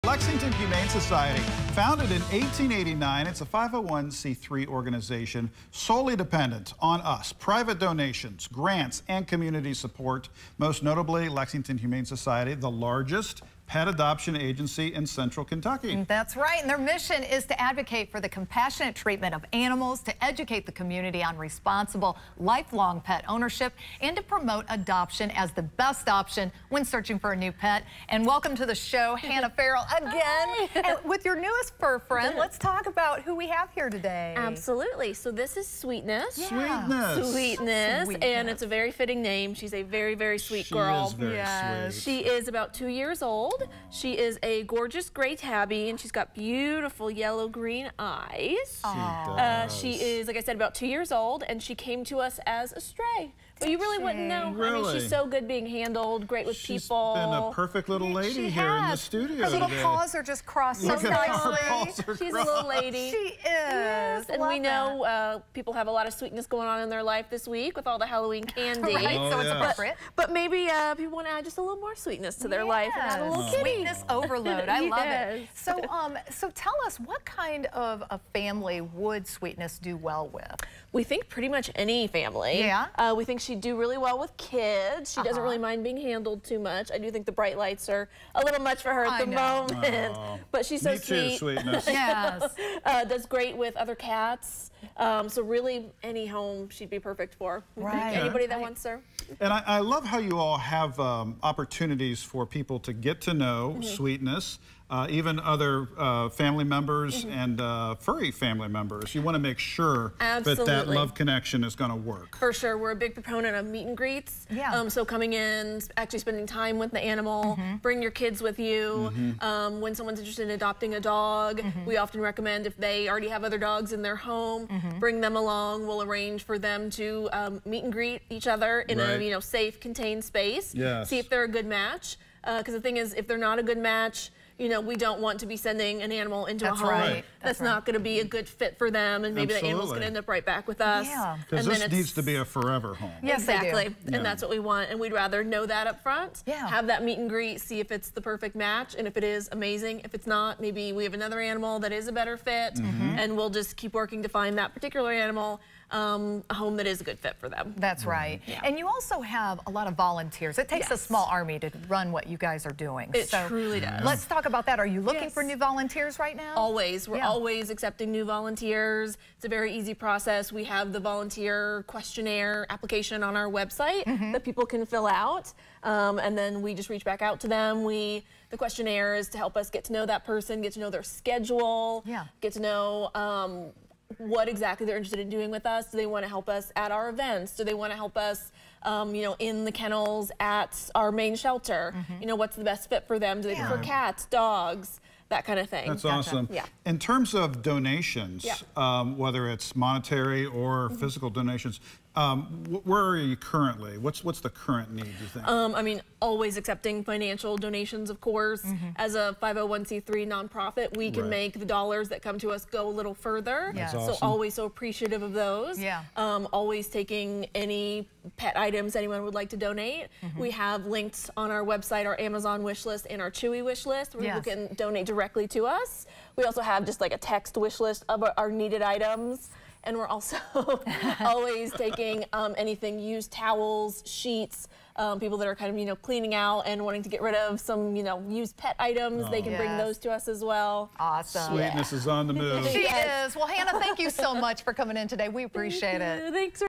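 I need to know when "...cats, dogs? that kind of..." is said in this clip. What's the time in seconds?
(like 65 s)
193 s.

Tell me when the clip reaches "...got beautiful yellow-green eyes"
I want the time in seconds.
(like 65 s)
46 s.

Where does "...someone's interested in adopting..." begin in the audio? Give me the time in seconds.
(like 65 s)
119 s.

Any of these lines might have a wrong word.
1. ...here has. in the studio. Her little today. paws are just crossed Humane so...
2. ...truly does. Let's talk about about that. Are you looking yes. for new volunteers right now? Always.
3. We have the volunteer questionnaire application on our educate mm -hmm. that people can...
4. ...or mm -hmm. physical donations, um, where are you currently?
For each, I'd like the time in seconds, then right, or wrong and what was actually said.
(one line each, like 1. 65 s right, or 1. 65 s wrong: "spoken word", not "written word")
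1. 58 s wrong: "Look", not "Humane"
2. 163 s right
3. 170 s wrong: "website", not "educate"
4. 200 s right.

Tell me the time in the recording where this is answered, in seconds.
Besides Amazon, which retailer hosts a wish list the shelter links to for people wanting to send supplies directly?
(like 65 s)
223 s.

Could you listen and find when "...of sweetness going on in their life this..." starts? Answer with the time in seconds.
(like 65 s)
66 s.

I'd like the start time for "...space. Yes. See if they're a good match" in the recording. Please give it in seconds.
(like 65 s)
130 s.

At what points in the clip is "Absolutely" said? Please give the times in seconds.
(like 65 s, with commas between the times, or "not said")
34 s, 110 s, 139 s.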